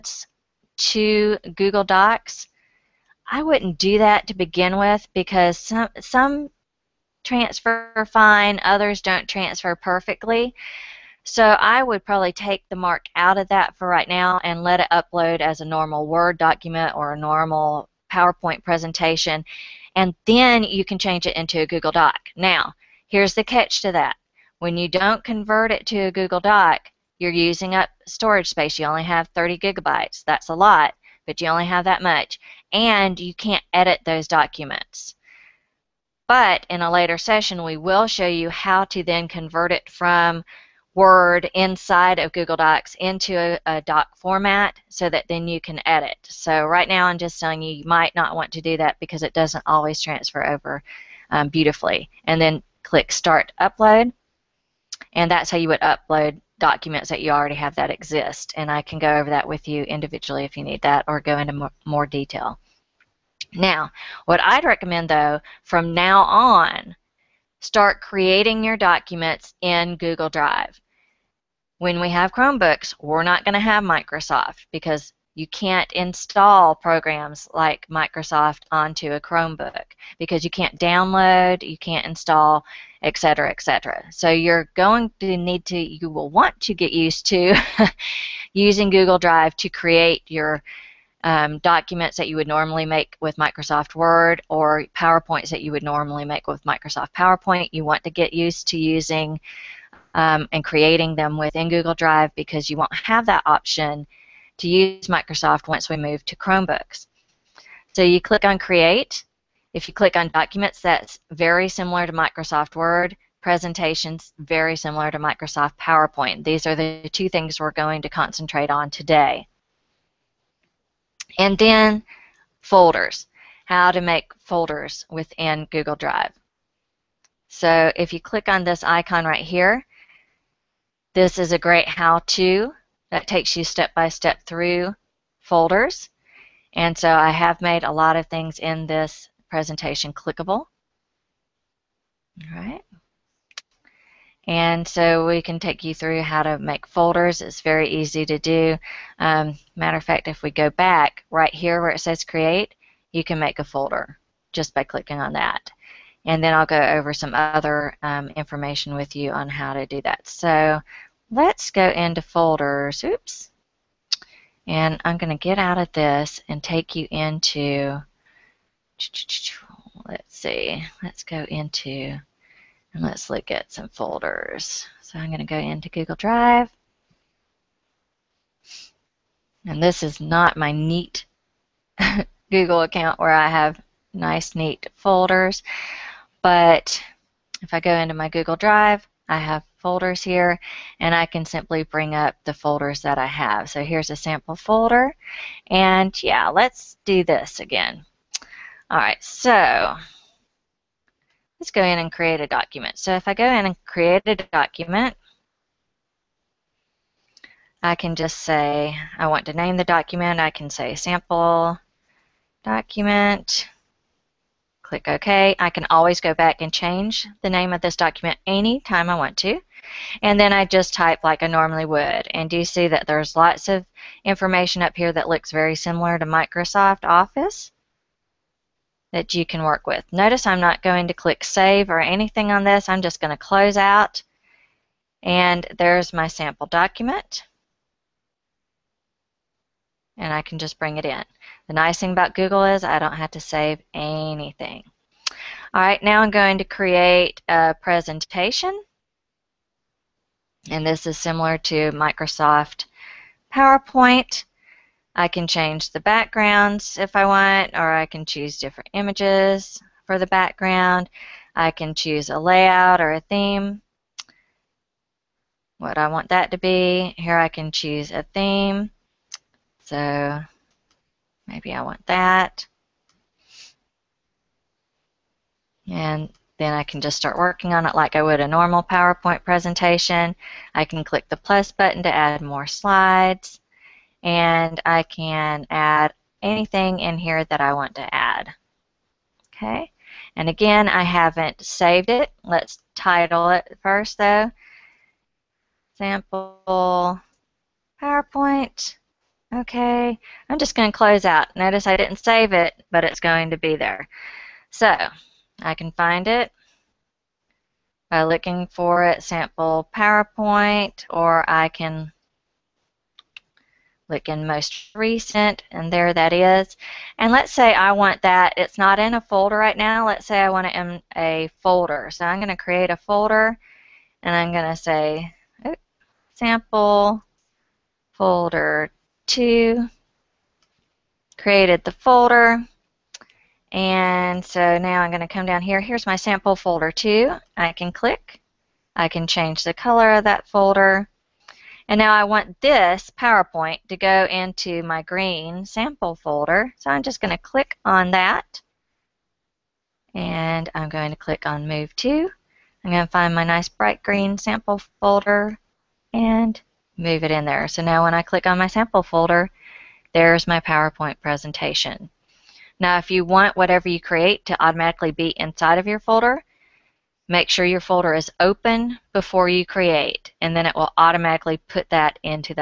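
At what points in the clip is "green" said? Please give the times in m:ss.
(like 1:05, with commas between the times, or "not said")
5:45, 5:54.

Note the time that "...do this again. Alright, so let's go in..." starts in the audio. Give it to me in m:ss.
3:17.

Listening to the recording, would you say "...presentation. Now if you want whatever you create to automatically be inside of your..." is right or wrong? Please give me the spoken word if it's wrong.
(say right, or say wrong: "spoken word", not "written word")
right.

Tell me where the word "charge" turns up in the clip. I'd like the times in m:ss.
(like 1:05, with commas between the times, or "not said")
not said.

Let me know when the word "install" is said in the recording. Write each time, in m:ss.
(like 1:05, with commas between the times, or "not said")
1:15, 1:22.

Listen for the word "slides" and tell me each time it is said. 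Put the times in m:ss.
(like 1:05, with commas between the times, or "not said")
4:42.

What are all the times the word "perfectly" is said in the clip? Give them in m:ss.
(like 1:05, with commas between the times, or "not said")
0:09.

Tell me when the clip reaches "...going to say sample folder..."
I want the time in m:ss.
5:24.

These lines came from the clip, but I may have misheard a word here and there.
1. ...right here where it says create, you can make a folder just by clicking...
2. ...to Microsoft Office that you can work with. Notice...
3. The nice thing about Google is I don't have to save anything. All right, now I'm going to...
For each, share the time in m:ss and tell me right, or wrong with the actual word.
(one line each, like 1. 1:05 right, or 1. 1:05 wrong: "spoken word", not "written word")
1. 2:31 right
2. 3:46 right
3. 4:01 right.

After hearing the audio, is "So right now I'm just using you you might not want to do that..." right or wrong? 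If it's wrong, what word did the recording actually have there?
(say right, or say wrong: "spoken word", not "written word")
wrong: "telling", not "using".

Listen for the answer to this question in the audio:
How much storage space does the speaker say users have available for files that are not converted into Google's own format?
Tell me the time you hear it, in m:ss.
0:29.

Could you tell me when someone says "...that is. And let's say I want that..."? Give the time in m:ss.
5:16.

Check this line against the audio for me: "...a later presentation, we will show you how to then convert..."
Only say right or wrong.
wrong.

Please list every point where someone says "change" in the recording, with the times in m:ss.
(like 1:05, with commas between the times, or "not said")
0:20, 3:36, 4:15, 5:39.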